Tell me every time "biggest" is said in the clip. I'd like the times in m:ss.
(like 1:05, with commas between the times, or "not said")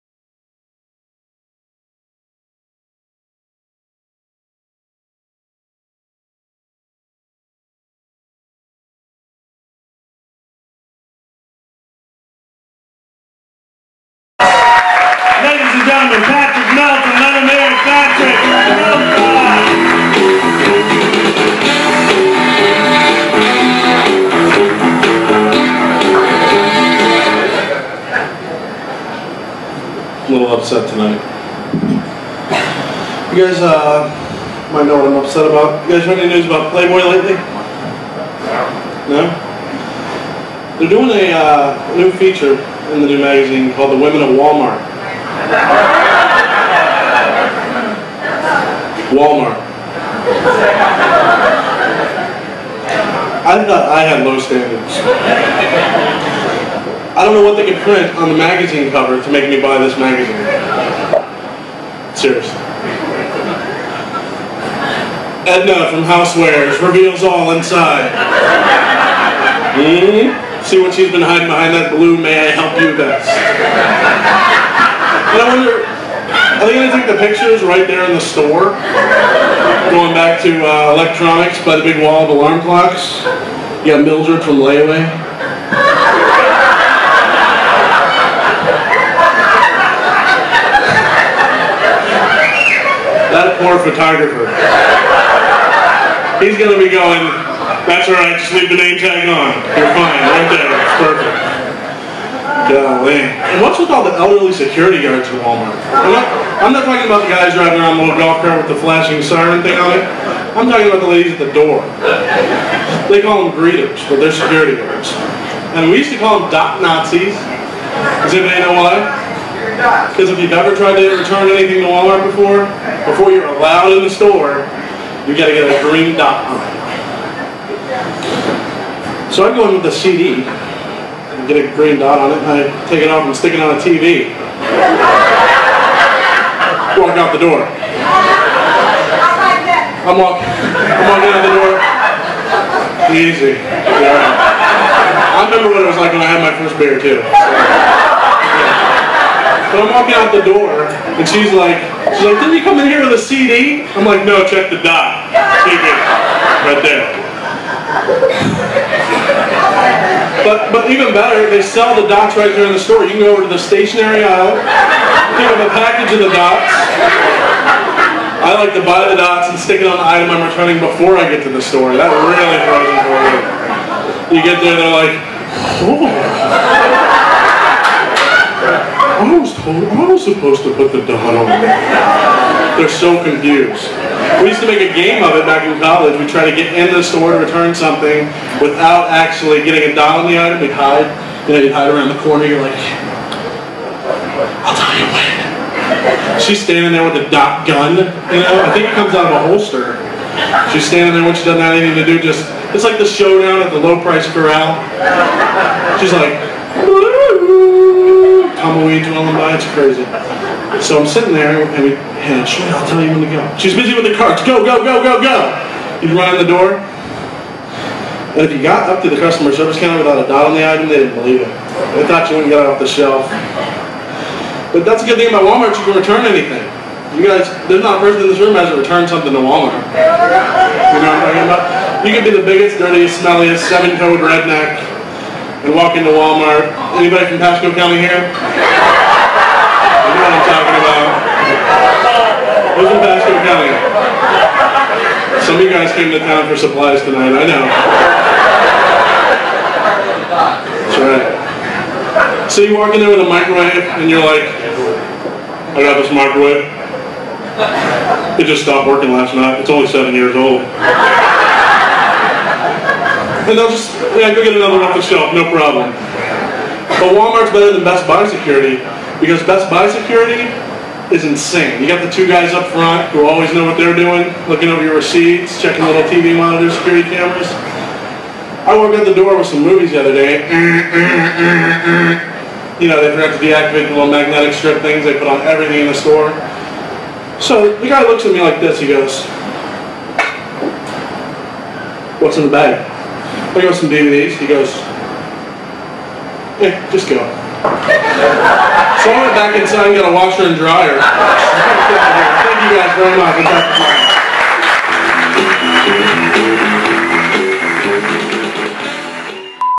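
3:52.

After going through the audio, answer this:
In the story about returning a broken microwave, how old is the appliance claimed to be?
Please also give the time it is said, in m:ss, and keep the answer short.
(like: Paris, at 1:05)
7 years, at 4:19.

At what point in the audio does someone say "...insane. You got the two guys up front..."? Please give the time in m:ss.
4:31.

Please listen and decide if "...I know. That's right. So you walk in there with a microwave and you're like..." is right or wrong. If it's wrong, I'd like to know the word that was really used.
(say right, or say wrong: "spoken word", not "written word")
right.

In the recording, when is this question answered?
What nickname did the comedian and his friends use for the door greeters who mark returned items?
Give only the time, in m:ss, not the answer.
1:56.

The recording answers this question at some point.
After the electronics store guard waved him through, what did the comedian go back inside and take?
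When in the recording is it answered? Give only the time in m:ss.
5:00.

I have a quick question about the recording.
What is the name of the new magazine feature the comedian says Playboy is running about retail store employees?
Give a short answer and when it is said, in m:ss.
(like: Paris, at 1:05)
The Women of Walmart, at 0:43.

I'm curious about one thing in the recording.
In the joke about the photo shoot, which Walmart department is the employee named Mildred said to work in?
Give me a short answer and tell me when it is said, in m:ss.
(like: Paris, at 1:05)
Layaway, at 1:24.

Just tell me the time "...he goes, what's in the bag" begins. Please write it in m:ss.
4:48.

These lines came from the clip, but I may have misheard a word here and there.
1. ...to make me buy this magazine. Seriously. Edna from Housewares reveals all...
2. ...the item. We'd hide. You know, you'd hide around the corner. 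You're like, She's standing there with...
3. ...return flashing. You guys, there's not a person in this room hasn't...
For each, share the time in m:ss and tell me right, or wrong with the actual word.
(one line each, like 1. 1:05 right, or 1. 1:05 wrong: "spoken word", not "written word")
1. 0:59 right
2. 3:10 right
3. 3:45 wrong: "anything", not "flashing".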